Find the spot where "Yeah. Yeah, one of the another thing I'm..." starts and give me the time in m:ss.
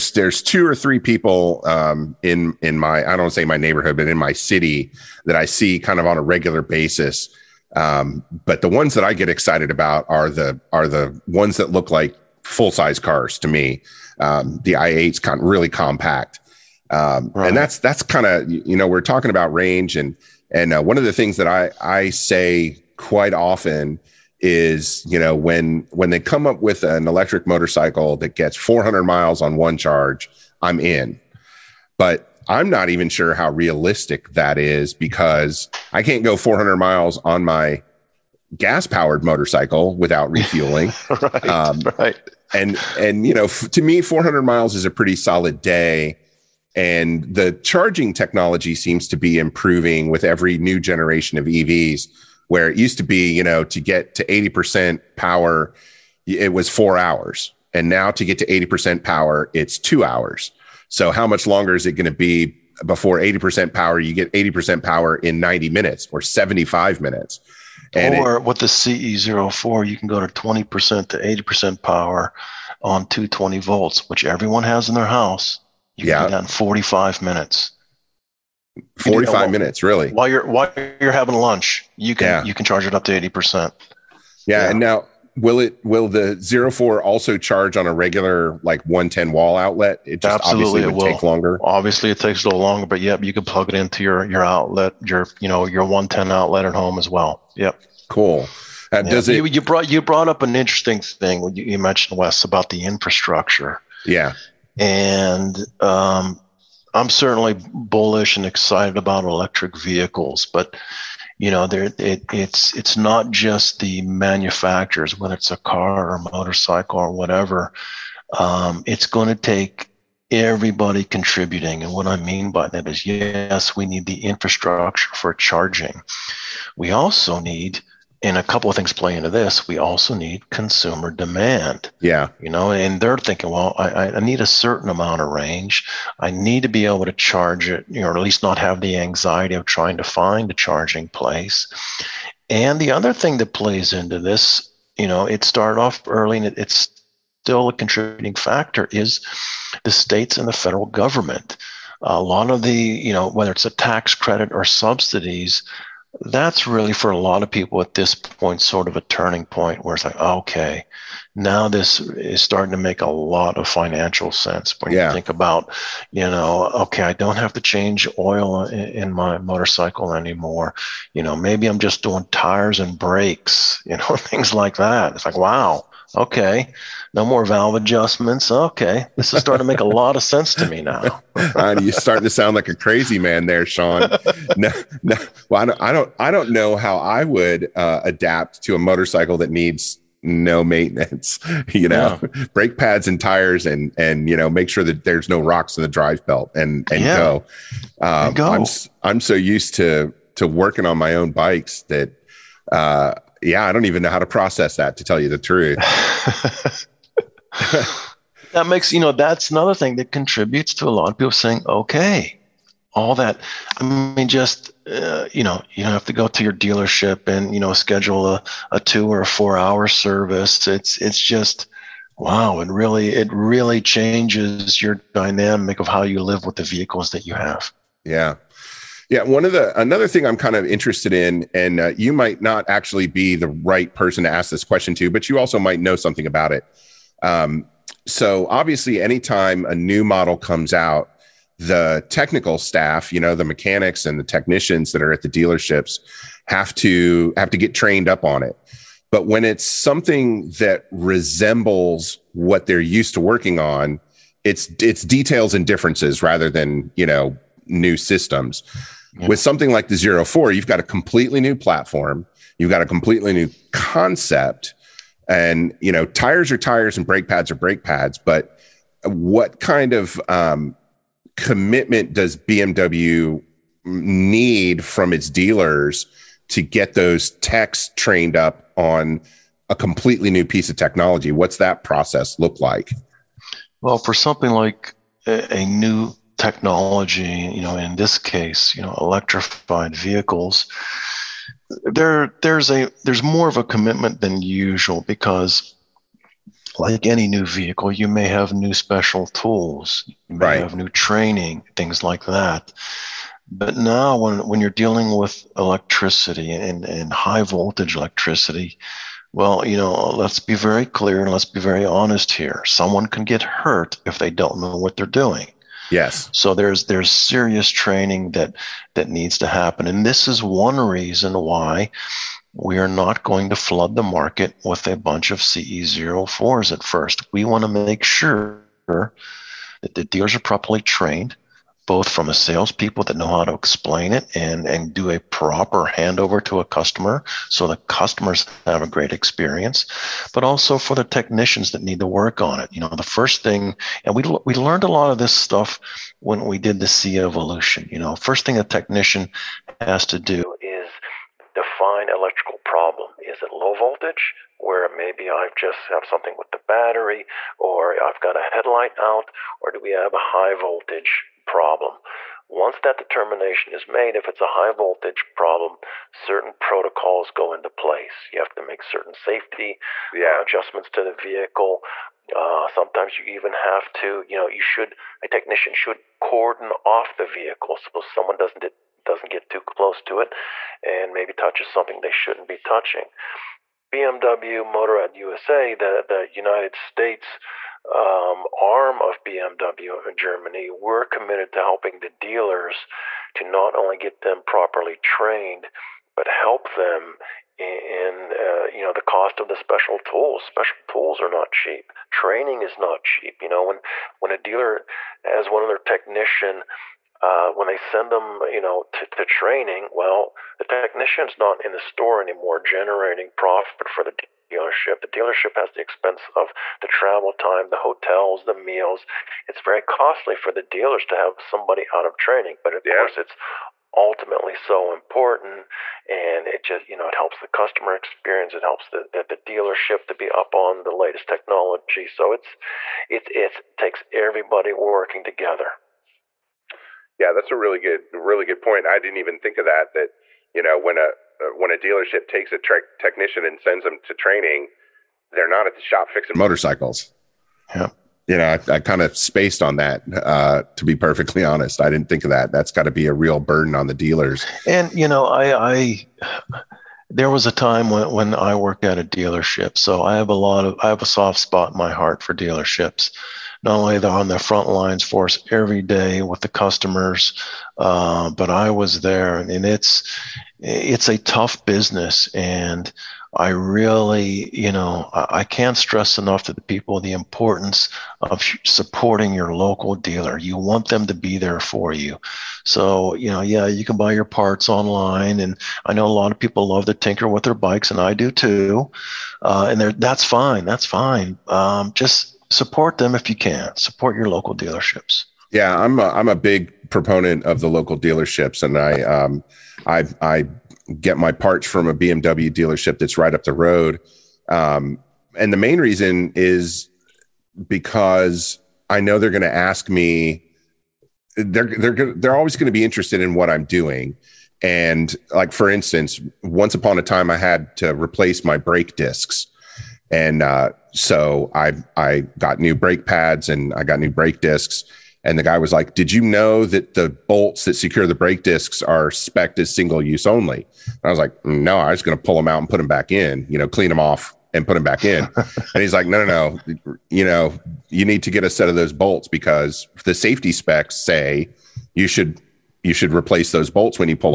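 3:48.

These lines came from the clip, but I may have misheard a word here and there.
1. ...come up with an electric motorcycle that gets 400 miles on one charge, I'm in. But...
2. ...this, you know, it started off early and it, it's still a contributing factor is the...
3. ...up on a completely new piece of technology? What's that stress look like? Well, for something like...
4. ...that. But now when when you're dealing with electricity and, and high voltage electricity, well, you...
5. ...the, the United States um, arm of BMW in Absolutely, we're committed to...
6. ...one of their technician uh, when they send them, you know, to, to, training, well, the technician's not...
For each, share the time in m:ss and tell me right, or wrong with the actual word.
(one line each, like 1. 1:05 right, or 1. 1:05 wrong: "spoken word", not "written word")
1. 0:26 right
2. 2:24 right
3. 4:38 wrong: "process", not "stress"
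4. 5:02 right
5. 6:25 wrong: "Germany", not "Absolutely"
6. 6:45 right.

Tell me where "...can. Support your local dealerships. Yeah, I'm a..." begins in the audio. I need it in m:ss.
8:13.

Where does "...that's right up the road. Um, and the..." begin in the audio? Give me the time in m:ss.
8:22.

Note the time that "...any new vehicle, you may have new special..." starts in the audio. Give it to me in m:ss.
4:57.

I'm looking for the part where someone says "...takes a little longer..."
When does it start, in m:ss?
1:32.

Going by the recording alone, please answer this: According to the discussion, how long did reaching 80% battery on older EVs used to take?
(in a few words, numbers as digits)
four hours.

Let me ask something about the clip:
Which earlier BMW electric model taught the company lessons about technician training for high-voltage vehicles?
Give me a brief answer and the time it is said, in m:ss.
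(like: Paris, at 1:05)
C evolution, at 5:46.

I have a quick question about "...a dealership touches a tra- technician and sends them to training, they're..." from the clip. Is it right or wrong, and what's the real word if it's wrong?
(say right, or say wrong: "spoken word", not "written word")
wrong: "takes", not "touches".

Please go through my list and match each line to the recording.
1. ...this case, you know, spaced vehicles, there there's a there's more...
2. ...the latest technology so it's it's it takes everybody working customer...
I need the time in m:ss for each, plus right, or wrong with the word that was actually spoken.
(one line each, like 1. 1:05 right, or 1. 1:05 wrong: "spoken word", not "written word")
1. 4:47 wrong: "electrified", not "spaced"
2. 7:10 wrong: "together", not "customer".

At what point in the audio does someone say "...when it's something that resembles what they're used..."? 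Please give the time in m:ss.
4:09.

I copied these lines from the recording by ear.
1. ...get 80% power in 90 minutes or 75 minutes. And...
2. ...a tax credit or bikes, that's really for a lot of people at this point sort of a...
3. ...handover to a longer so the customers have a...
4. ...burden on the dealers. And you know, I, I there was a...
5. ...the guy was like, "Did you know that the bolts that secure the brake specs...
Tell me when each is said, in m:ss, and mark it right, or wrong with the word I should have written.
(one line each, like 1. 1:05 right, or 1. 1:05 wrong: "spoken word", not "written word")
1. 1:04 right
2. 2:33 wrong: "subsidies", not "bikes"
3. 5:35 wrong: "customer", not "longer"
4. 7:33 right
5. 8:45 wrong: "discs", not "specs".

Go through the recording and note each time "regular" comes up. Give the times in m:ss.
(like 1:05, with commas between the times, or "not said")
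0:06, 1:27.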